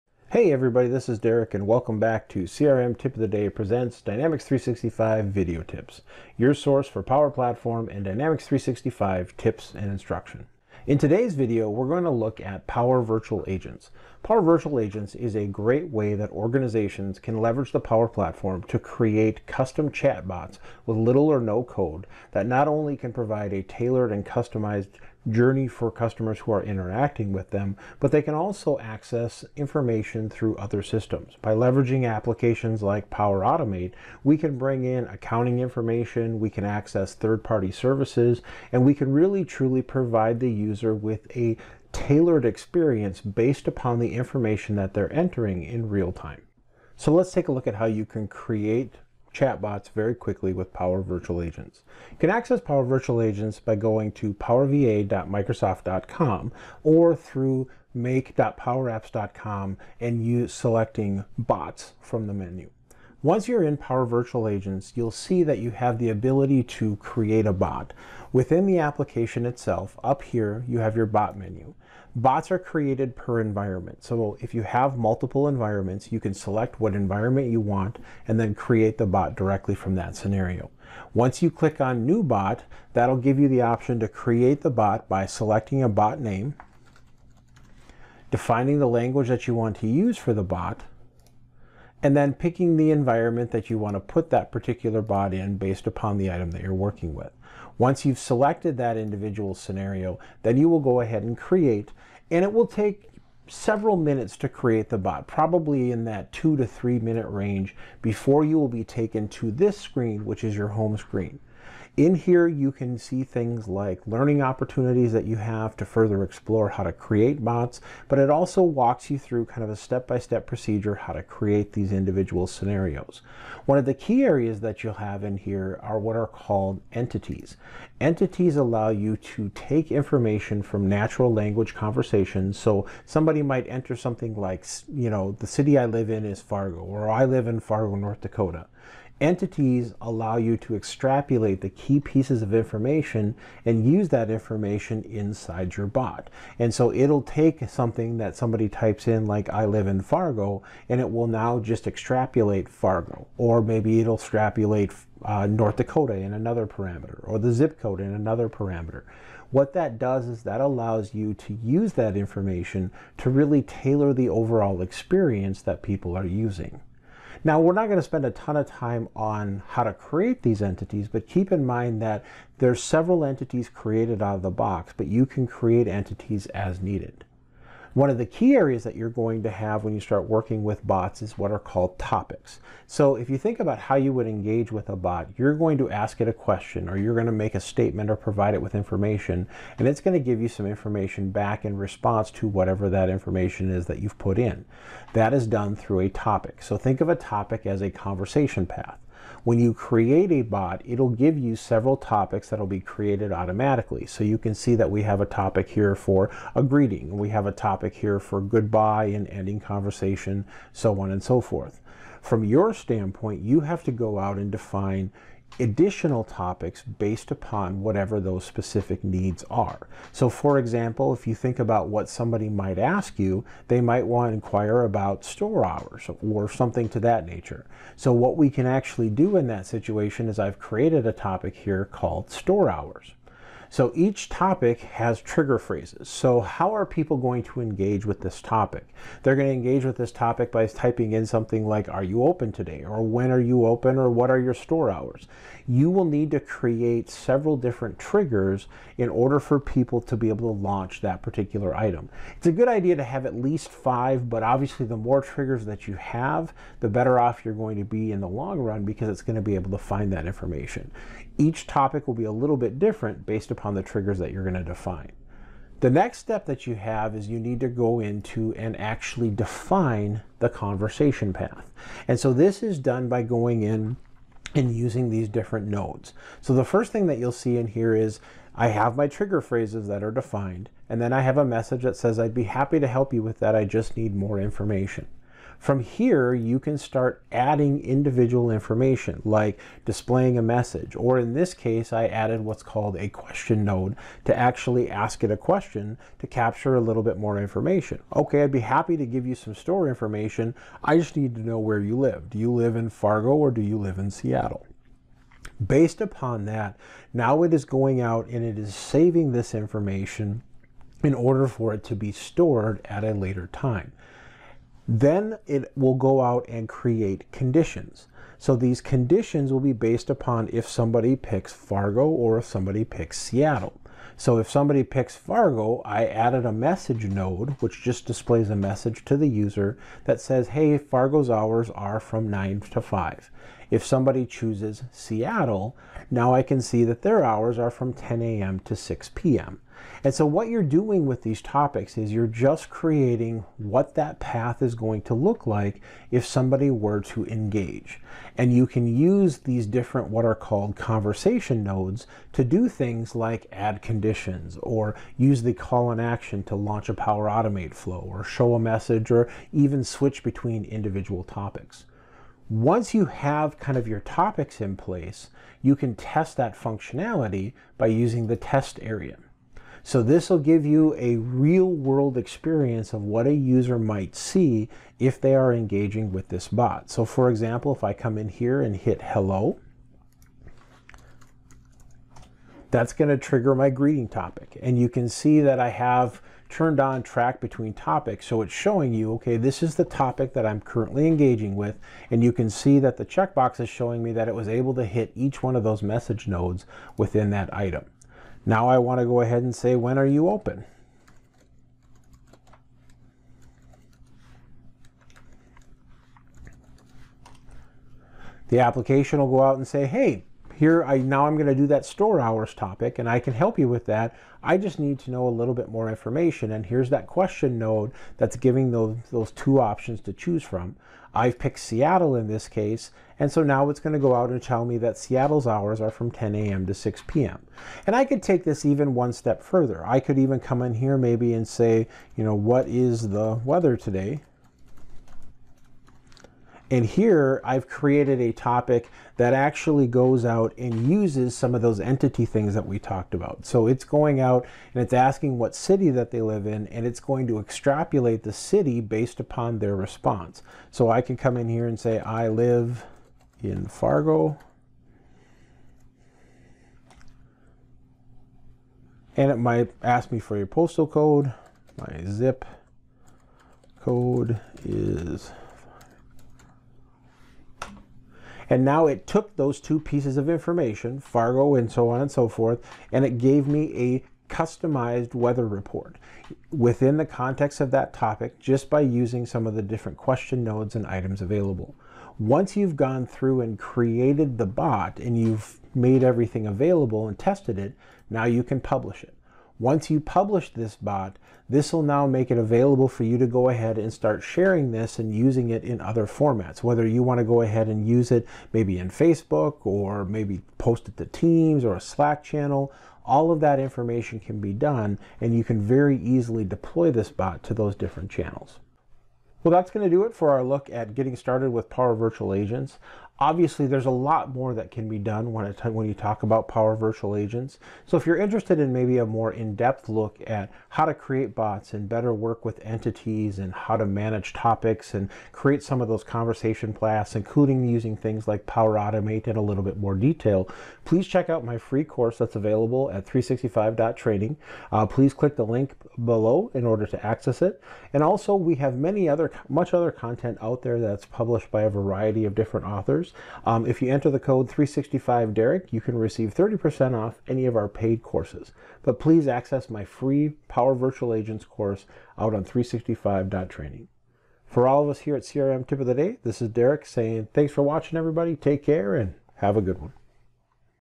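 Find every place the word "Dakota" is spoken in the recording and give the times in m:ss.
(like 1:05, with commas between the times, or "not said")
2:18, 2:35.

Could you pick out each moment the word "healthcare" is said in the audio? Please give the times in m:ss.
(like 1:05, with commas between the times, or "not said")
not said.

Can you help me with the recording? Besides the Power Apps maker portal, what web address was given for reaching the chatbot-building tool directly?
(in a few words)
powerva.microsoft.com.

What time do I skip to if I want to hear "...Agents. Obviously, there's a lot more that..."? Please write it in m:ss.
8:32.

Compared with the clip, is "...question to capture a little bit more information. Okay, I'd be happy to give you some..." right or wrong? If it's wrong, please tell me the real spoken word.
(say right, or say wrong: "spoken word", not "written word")
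right.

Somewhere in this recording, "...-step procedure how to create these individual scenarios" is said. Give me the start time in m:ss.
2:00.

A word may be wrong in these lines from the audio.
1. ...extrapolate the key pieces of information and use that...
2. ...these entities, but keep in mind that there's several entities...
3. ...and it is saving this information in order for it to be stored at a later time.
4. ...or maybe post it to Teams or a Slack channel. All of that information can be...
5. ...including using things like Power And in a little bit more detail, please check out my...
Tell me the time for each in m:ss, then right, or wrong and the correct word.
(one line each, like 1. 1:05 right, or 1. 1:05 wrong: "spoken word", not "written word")
1. 2:20 right
2. 2:50 right
3. 5:08 right
4. 8:19 right
5. 8:47 wrong: "Automate", not "And".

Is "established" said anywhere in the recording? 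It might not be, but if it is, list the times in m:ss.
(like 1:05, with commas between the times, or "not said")
not said.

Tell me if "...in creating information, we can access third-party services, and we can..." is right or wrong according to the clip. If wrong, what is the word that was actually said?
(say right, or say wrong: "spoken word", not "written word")
wrong: "accounting", not "creating".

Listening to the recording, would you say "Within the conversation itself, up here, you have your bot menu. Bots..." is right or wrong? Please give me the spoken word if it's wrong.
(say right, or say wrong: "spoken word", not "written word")
wrong: "application", not "conversation".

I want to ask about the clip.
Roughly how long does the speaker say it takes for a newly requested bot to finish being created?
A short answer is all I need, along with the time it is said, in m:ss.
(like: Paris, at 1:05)
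2 to 3 minutes, at 1:46.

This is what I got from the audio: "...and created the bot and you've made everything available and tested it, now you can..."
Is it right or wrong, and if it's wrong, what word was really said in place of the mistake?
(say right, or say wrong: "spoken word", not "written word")
right.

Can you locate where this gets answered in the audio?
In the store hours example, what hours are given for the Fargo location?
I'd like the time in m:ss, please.
5:32.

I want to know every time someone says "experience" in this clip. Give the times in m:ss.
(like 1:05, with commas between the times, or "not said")
0:42, 2:44, 6:12.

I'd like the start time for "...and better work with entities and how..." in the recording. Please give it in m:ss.
8:41.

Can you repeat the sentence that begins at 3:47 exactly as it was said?
So what we can actually do in that situation is I've created a topic here called store hours.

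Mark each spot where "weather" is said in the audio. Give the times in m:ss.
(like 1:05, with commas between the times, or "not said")
7:13, 7:55.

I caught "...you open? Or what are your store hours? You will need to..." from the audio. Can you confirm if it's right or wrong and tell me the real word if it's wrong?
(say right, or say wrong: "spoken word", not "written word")
right.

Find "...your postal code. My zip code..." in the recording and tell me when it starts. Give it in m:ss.
7:40.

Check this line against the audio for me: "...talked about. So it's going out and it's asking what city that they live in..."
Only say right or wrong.
right.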